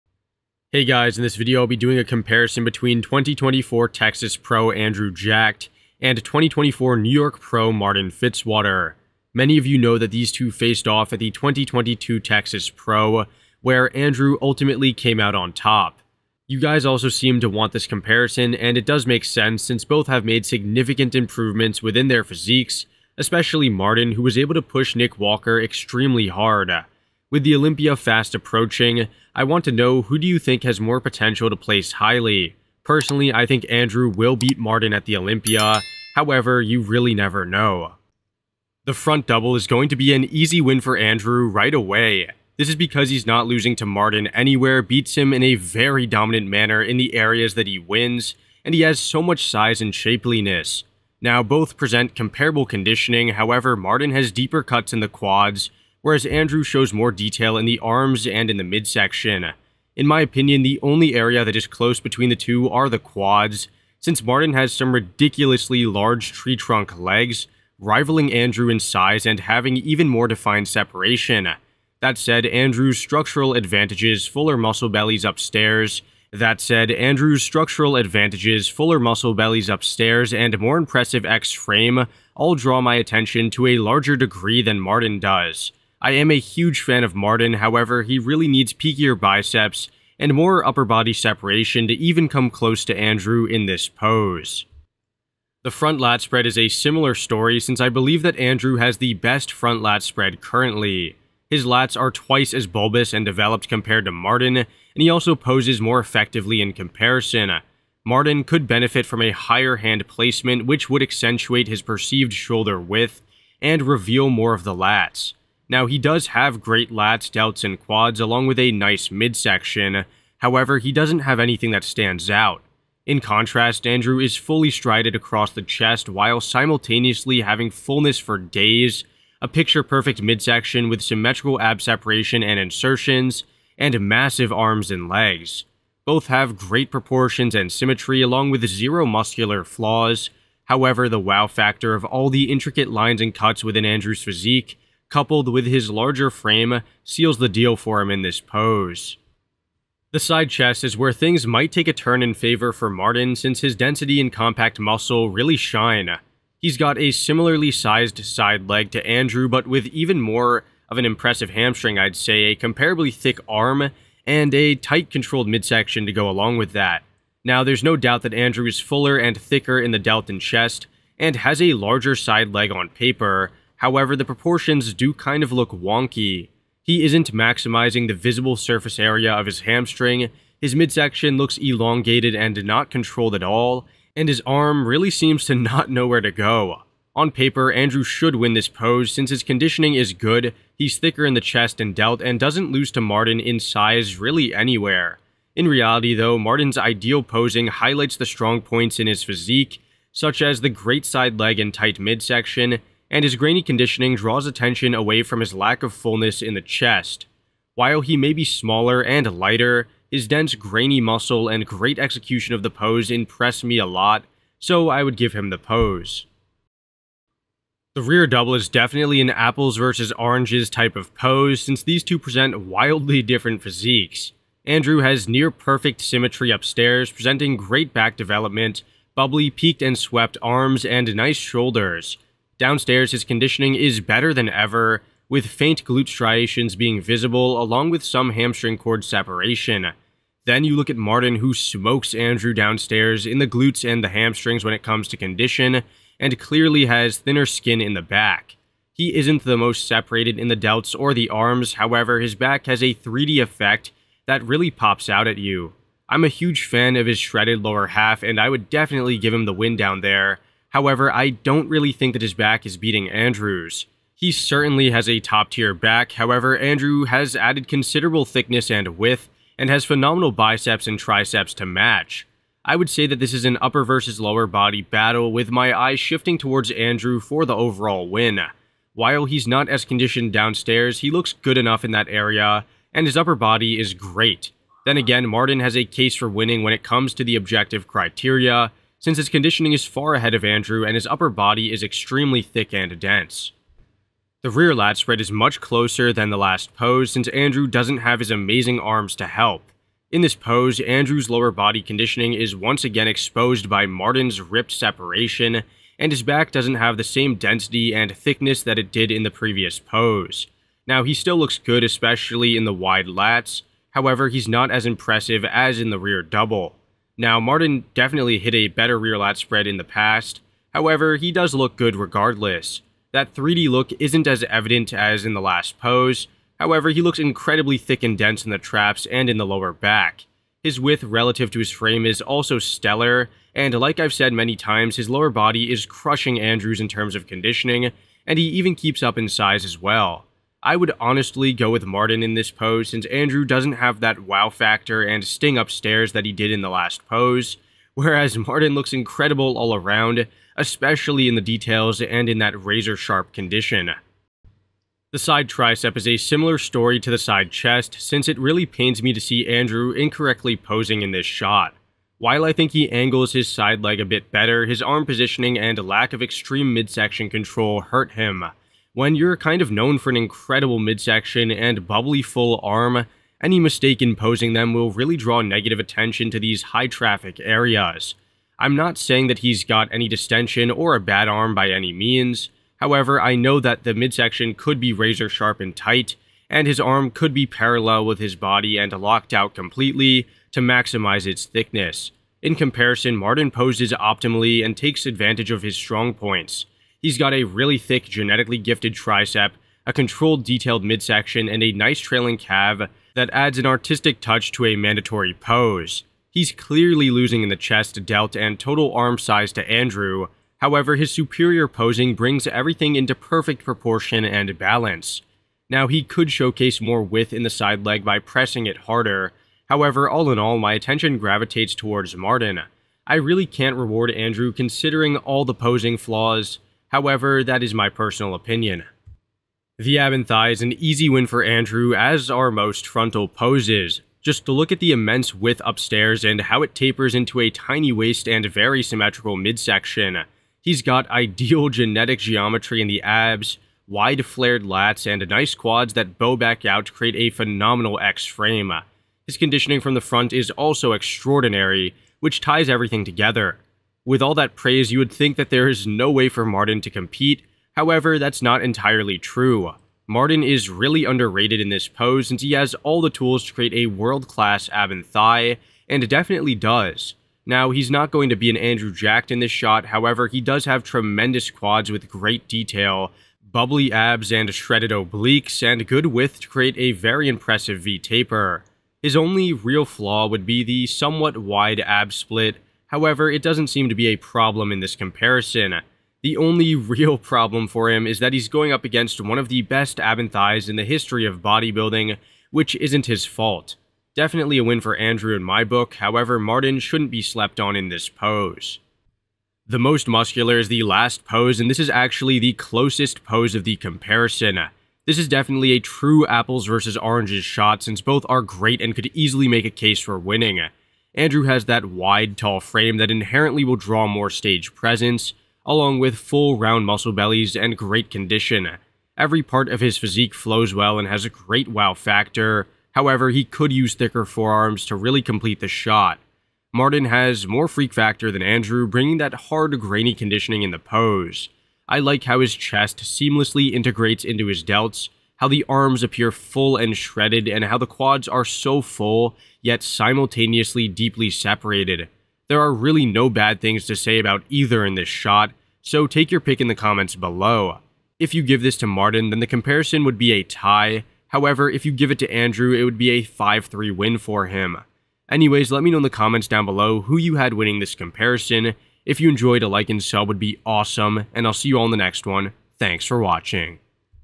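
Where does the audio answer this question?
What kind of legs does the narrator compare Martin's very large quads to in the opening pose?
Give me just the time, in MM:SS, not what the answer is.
01:06.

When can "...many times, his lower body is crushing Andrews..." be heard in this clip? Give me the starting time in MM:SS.
05:34.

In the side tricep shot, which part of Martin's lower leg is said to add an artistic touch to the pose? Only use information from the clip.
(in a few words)
Trailing calf.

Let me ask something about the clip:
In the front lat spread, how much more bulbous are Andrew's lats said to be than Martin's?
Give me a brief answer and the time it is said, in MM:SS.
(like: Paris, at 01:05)
Twice, at 01:42.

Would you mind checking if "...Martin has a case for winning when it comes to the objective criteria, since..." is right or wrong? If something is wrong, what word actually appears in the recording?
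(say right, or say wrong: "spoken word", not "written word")
right.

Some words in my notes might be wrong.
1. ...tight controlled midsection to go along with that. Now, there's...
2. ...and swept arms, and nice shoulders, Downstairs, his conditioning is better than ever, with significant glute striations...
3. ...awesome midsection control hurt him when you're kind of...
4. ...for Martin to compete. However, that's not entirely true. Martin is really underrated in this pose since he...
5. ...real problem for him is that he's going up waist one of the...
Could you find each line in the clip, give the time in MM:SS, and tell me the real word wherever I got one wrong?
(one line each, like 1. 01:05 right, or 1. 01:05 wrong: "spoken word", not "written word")
1. 02:44 right
2. 03:49 wrong: "faint", not "significant"
3. 06:06 wrong: "extreme", not "awesome"
4. 07:36 right
5. 08:06 wrong: "against", not "waist".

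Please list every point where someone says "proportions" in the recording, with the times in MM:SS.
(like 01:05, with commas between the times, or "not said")
02:16, 02:54, 06:53.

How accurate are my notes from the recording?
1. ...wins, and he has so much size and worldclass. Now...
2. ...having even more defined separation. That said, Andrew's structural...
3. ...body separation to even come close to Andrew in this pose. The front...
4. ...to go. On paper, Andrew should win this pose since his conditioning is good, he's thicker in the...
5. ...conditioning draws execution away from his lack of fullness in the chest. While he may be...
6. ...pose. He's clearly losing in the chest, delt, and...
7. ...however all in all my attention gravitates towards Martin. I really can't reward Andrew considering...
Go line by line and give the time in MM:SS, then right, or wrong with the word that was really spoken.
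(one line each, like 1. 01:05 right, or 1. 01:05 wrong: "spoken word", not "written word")
1. 00:47 wrong: "shapeliness", not "worldclass"
2. 01:09 right
3. 01:30 right
4. 03:06 right
5. 03:23 wrong: "attention", not "execution"
6. 06:45 right
7. 06:59 right.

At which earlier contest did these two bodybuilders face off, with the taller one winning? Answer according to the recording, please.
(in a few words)
2022 Texas Pro.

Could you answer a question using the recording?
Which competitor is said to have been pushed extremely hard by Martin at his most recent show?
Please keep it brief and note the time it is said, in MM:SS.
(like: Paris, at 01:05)
Nick Walker, at 00:24.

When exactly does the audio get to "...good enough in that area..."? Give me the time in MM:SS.
04:41.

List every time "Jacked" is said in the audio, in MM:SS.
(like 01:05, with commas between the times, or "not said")
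00:05, 07:48.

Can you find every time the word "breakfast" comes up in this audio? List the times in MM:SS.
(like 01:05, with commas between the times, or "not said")
not said.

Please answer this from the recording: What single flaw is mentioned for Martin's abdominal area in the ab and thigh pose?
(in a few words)
Wide ab split.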